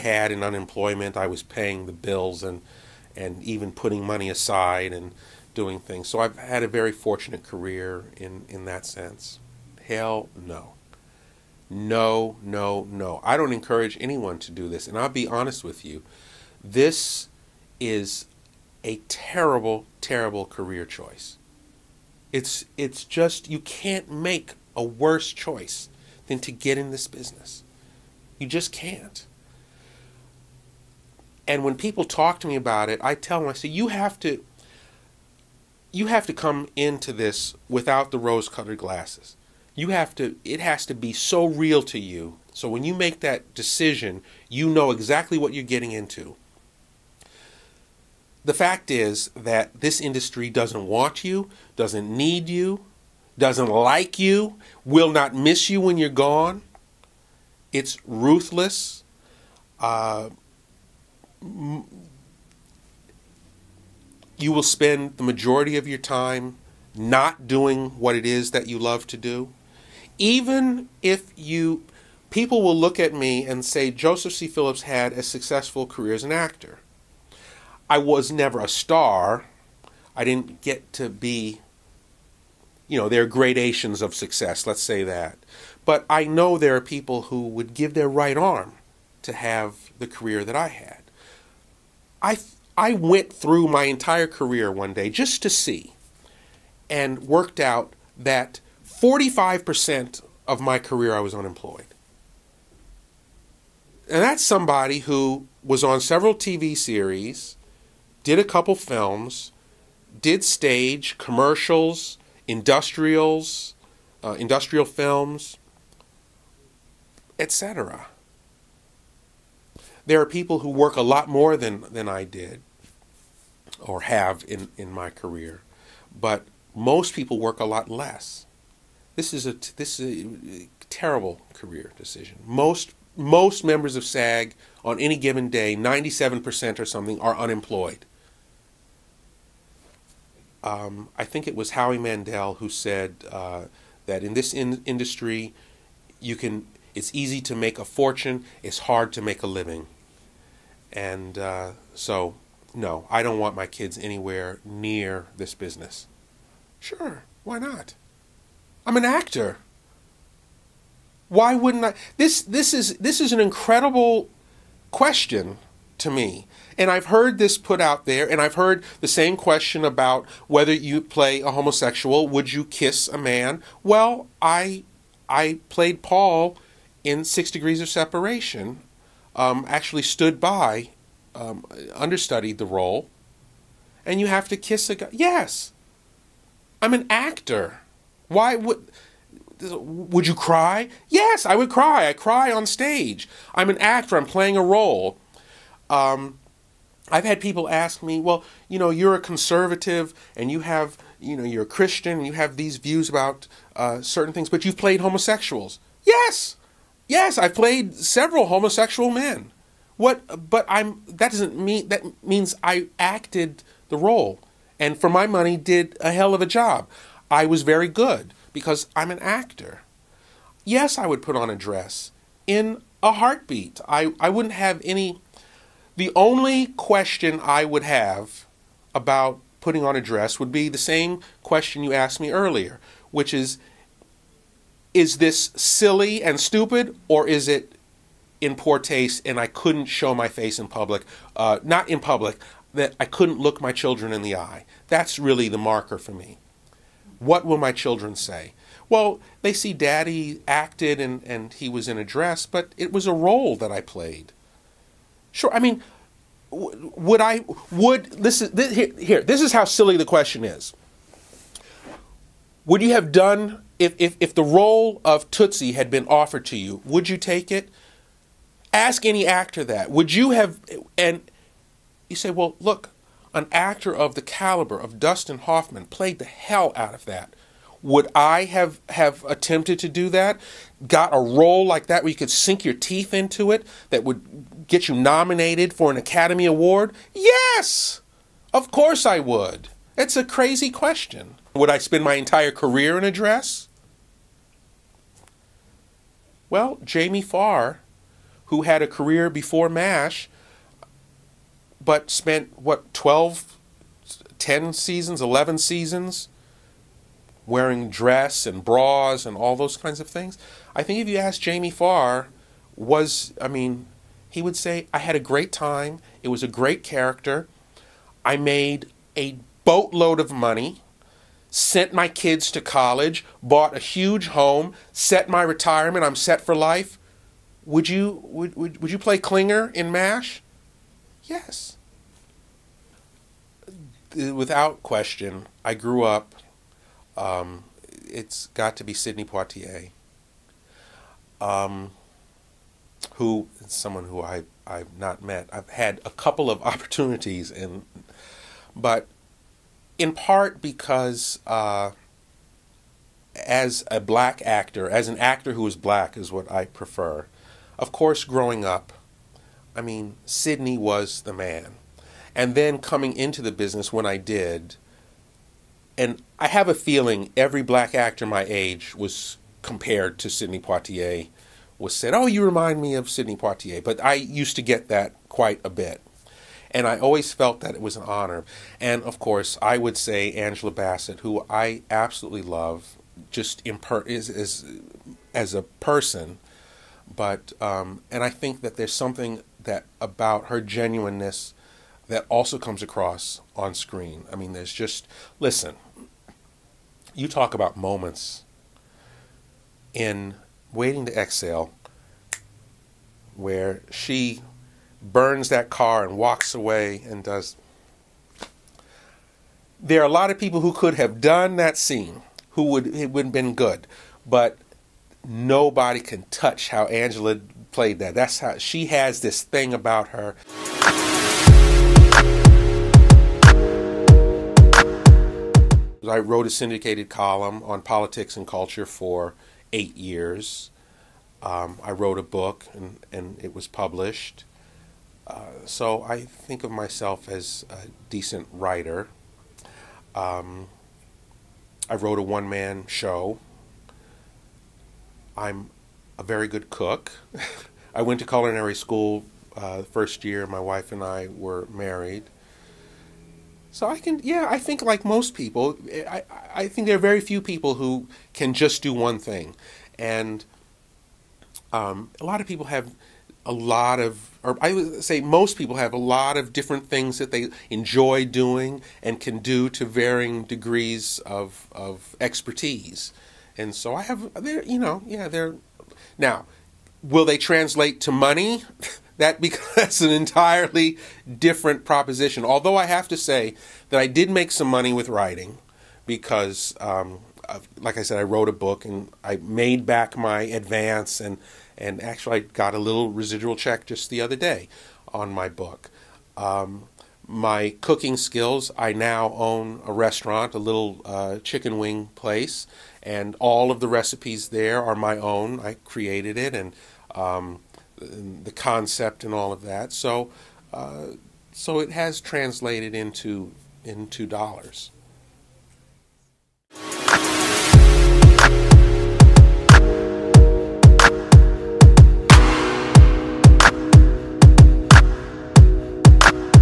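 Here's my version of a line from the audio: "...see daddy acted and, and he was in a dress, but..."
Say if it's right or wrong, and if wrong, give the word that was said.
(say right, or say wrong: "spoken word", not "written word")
right.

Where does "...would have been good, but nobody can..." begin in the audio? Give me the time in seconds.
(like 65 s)
413 s.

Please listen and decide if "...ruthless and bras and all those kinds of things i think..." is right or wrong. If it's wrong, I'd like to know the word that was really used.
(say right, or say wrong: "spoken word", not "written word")
wrong: "dress", not "ruthless".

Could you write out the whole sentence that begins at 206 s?
Yes, yes, I've played several homosexual men.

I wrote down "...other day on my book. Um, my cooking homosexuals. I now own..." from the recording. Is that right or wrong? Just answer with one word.
wrong.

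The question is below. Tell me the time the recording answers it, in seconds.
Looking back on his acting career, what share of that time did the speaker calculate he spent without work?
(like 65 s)
99 s.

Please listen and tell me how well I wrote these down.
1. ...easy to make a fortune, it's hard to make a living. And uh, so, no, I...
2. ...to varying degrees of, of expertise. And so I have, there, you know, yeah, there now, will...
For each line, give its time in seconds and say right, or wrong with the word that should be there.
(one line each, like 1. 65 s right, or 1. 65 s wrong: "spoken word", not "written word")
1. 147 s right
2. 469 s right.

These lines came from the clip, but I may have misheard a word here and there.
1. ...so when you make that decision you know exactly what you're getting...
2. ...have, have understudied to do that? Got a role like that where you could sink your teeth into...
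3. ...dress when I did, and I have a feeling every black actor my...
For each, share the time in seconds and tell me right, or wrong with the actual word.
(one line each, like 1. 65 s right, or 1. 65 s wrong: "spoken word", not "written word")
1. 42 s right
2. 278 s wrong: "attempted", not "understudied"
3. 363 s wrong: "business", not "dress".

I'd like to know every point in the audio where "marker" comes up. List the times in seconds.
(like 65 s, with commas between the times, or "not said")
245 s.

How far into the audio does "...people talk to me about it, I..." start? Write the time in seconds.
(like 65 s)
31 s.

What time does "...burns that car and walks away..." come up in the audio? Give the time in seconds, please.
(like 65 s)
405 s.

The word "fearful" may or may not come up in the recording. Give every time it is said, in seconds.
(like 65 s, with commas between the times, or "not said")
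not said.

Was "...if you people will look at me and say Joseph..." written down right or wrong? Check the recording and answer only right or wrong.
right.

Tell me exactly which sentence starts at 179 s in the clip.
Um, actually stood by, um, understudied the role, and you have to kiss a guy.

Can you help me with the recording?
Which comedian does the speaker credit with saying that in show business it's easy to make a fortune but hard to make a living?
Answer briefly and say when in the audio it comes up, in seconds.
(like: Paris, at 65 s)
Howie Mandel, at 141 s.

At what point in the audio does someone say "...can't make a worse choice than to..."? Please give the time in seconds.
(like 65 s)
23 s.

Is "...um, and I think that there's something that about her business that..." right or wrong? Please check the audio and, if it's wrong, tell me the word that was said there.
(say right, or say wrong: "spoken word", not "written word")
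wrong: "genuineness", not "business".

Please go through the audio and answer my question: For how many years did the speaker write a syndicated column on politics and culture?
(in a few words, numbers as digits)
8.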